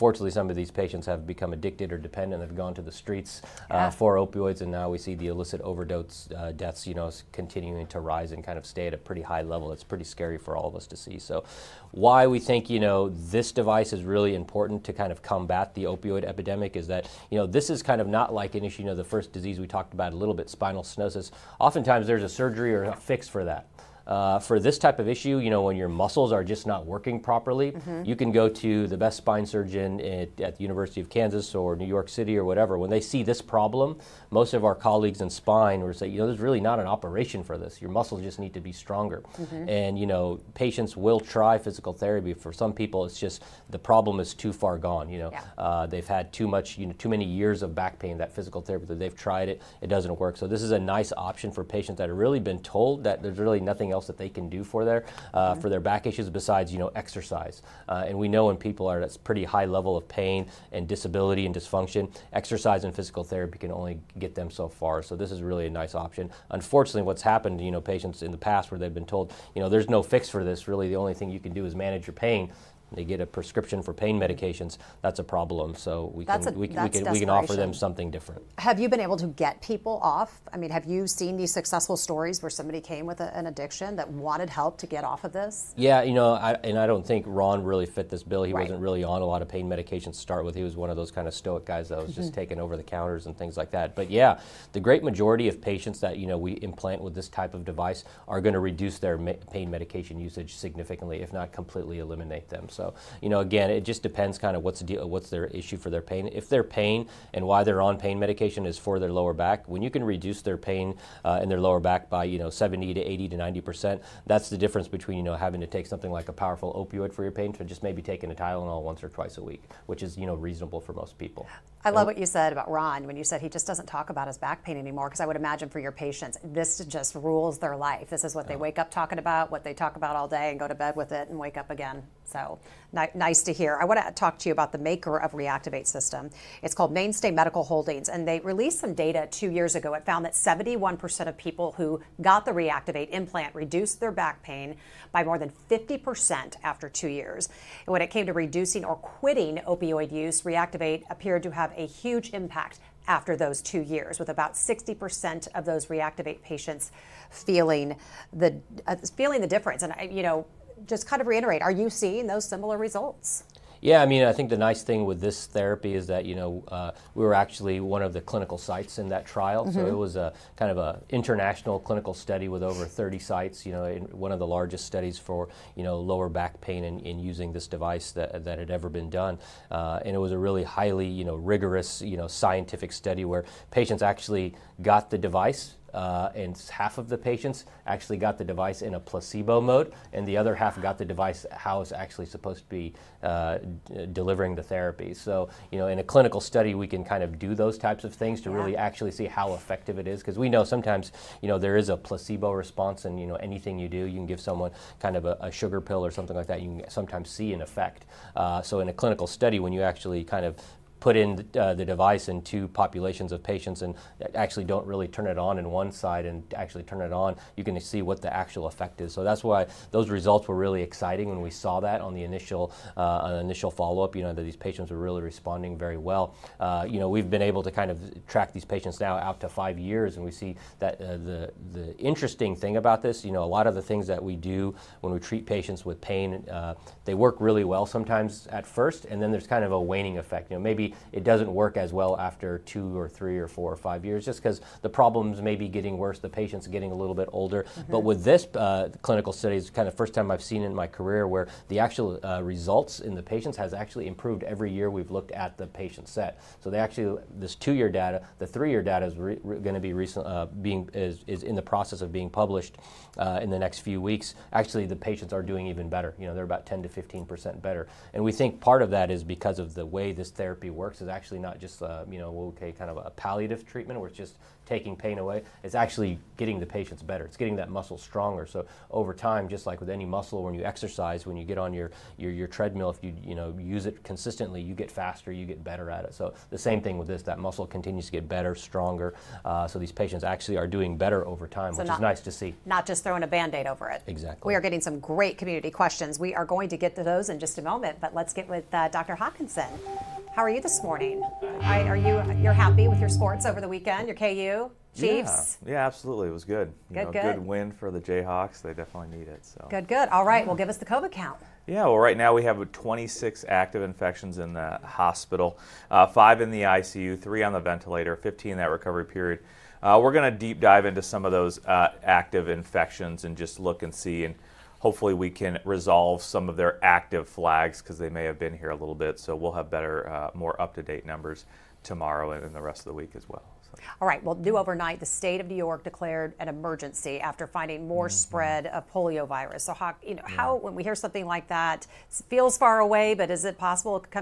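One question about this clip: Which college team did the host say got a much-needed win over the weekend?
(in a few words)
Jayhawks.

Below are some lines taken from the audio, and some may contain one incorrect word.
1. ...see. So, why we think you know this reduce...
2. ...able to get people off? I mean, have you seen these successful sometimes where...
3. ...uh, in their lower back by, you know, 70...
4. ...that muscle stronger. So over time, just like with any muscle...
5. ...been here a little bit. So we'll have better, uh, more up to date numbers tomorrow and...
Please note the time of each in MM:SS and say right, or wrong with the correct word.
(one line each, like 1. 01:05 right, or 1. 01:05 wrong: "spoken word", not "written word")
1. 00:10 wrong: "device", not "reduce"
2. 01:19 wrong: "stories", not "sometimes"
3. 01:51 right
4. 04:37 right
5. 05:28 right.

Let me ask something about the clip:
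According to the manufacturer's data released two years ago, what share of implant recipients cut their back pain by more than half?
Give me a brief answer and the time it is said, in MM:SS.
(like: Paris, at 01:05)
71%, at 02:20.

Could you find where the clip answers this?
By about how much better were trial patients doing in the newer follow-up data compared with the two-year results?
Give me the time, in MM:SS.
04:26.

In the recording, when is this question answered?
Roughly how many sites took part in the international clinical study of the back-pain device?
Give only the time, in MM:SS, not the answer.
02:52.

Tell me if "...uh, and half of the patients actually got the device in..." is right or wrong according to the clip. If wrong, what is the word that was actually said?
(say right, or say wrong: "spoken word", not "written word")
right.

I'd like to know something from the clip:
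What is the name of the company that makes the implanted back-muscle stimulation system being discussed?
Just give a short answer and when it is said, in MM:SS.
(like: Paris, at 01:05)
Mainstay Medical Holdings, at 02:16.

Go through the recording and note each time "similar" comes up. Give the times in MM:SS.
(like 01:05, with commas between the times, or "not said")
02:42.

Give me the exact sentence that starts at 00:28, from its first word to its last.
you can go to the best spine surgeon at, at, the University of Kansas or New York City or whatever.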